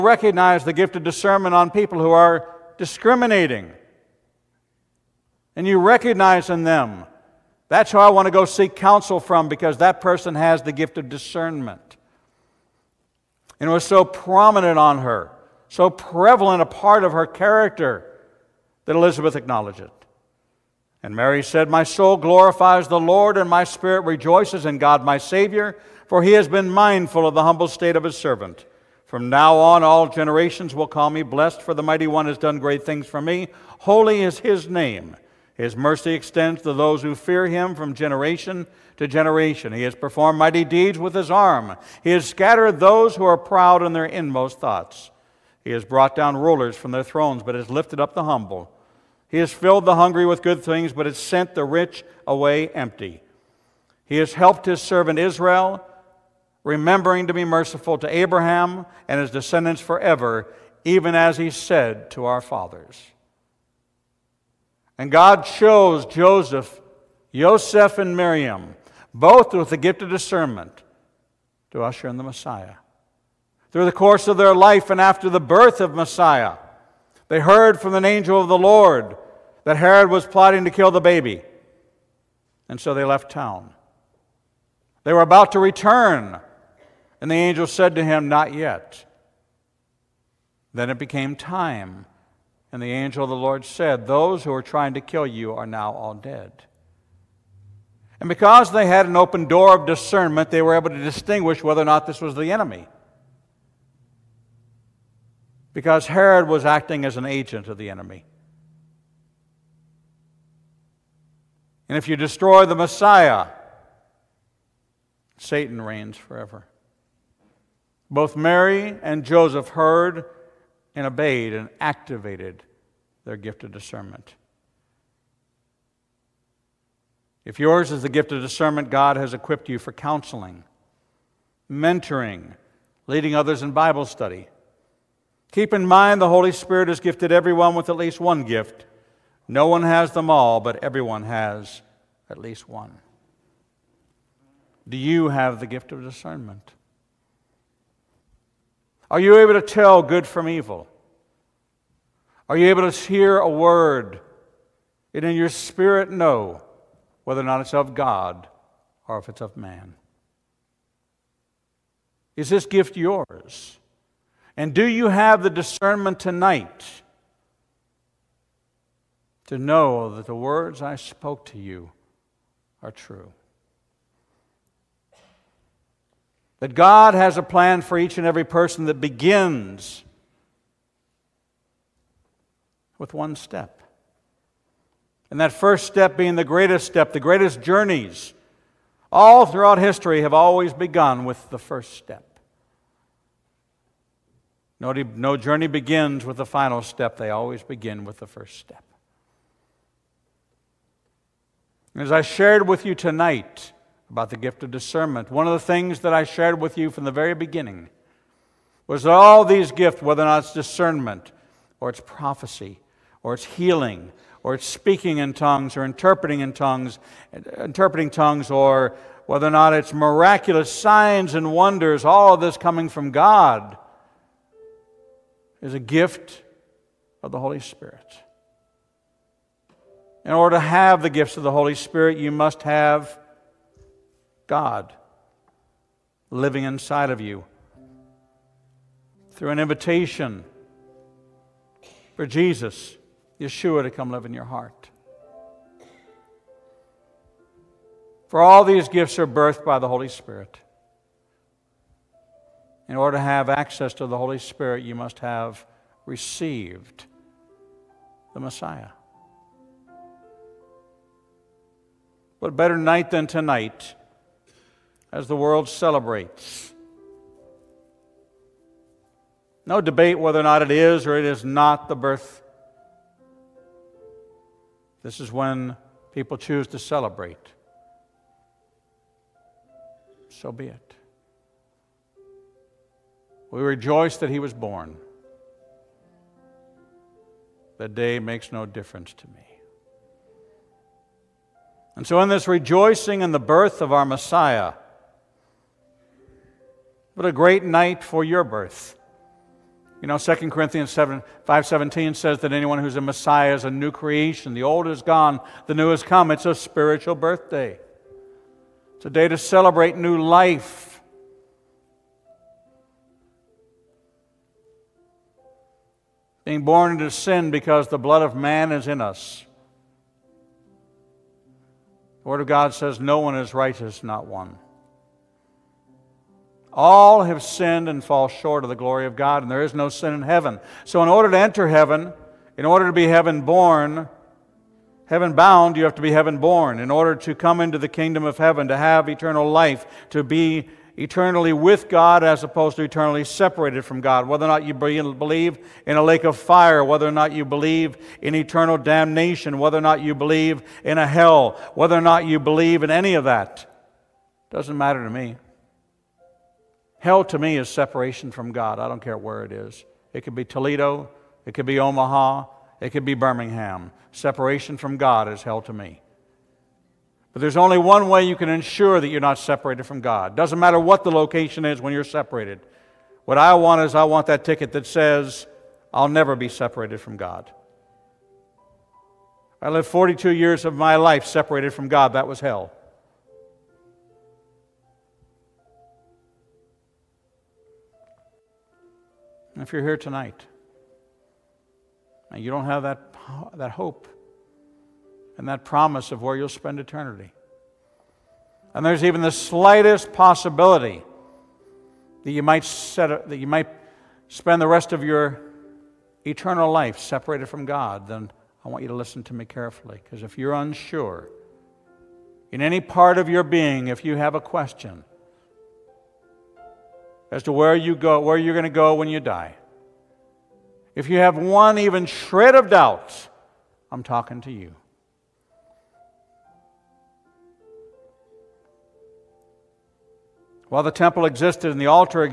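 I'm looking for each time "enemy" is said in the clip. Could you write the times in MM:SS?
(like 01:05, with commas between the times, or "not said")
01:42, 01:47.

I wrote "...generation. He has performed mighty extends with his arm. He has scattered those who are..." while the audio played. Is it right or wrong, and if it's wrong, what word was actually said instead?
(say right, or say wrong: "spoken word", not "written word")
wrong: "deeds", not "extends".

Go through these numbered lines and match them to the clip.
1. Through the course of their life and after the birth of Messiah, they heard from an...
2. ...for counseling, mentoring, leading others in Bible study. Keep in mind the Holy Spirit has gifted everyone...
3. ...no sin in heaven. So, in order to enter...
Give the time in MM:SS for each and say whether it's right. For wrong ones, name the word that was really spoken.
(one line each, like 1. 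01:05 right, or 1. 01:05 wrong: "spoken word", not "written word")
1. 01:13 right
2. 02:09 right
3. 05:29 right.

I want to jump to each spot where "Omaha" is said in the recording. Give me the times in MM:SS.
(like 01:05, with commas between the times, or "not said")
06:01.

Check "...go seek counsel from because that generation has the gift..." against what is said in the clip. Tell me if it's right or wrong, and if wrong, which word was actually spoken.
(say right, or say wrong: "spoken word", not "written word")
wrong: "person", not "generation".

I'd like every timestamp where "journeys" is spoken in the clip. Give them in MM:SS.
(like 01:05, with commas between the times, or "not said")
03:07, 03:15.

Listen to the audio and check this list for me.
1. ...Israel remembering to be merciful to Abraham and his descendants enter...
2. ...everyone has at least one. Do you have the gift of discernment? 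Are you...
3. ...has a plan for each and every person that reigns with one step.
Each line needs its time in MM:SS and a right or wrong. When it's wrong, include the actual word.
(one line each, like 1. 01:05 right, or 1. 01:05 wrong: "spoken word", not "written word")
1. 00:55 wrong: "forever", not "enter"
2. 02:20 right
3. 02:57 wrong: "begins", not "reigns".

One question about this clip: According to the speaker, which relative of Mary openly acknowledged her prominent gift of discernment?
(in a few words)
Elizabeth.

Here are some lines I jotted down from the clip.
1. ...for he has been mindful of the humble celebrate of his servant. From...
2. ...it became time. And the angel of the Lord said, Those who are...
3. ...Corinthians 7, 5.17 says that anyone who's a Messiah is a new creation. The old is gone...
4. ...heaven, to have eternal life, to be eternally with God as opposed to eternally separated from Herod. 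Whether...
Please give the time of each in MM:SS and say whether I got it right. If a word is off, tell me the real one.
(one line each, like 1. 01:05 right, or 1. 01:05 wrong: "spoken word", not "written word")
1. 00:26 wrong: "state", not "celebrate"
2. 01:30 right
3. 05:00 right
4. 05:38 wrong: "God", not "Herod".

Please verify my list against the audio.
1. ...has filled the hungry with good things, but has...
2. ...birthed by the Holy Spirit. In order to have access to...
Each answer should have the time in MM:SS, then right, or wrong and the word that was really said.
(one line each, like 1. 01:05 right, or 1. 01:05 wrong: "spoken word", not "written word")
1. 00:49 right
2. 04:09 right.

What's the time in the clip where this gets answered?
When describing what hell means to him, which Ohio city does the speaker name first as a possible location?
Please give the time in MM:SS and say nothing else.
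06:00.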